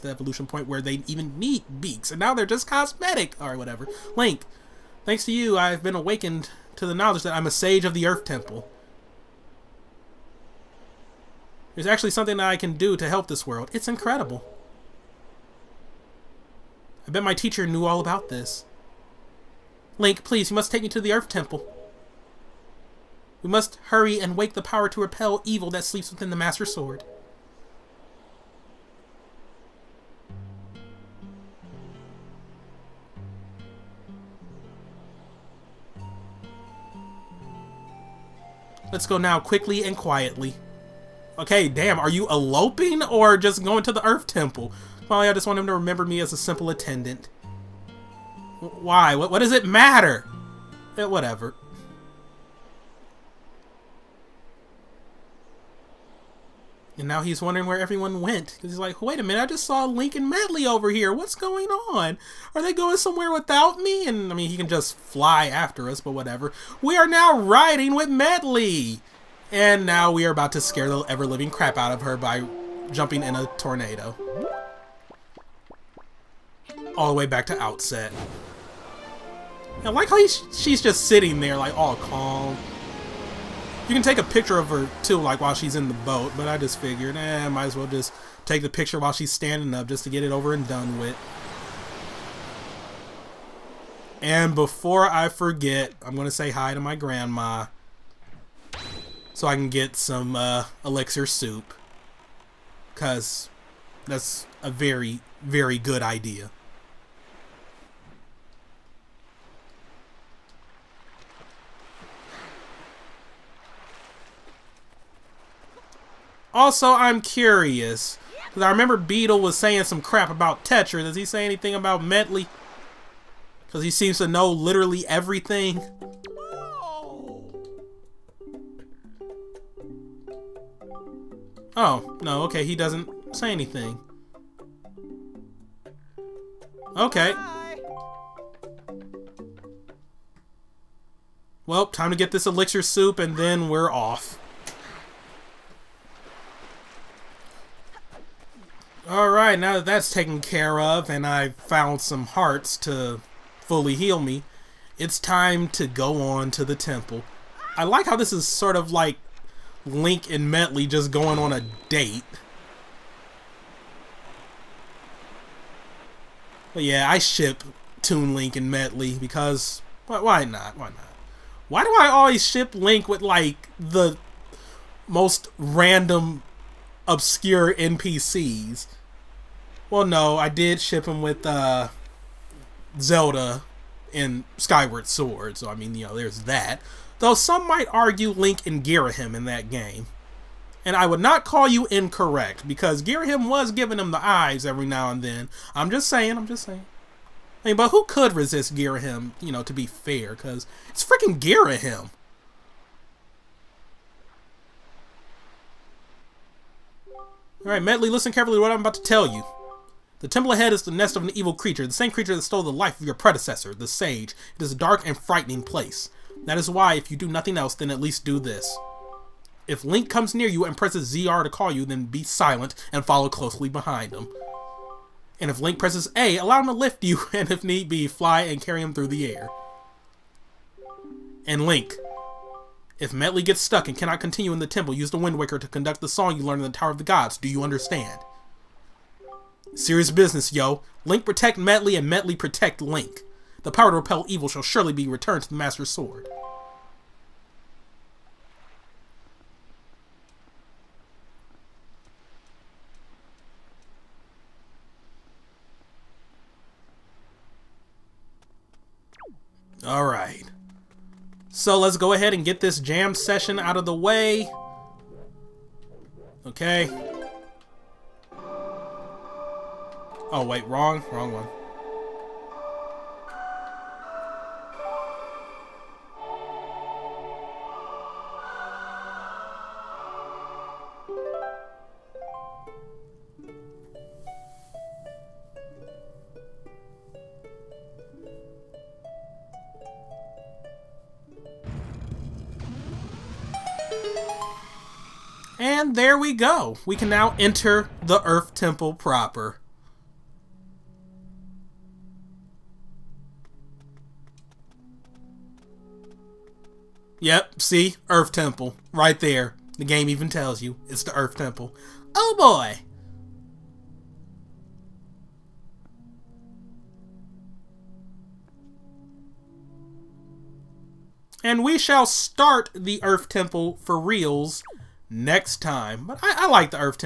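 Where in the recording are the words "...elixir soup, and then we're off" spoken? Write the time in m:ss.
2:22.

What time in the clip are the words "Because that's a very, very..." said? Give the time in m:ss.
1:42.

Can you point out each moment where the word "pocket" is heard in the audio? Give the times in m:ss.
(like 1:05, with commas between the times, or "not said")
not said.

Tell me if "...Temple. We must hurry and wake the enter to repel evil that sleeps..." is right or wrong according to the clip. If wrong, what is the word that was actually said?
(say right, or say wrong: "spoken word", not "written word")
wrong: "power", not "enter".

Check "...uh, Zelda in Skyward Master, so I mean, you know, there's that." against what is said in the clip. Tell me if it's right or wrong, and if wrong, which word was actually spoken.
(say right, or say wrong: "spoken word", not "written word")
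wrong: "Sword", not "Master".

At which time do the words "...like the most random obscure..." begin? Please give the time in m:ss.
2:53.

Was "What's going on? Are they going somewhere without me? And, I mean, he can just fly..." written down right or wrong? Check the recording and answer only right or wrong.
right.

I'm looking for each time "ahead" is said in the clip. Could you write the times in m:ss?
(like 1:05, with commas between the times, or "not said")
3:30, 4:22.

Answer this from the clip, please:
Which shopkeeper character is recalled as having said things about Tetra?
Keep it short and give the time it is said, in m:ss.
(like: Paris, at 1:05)
Beedle, at 1:58.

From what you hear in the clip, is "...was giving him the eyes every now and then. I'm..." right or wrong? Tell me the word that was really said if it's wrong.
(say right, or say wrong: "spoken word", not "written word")
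right.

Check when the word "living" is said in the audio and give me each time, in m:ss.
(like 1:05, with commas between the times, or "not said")
1:11.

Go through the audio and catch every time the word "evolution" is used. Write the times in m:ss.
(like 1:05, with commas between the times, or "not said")
0:00.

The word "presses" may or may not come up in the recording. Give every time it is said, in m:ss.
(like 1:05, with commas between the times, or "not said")
3:40, 3:45.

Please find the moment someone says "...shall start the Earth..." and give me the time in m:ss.
5:21.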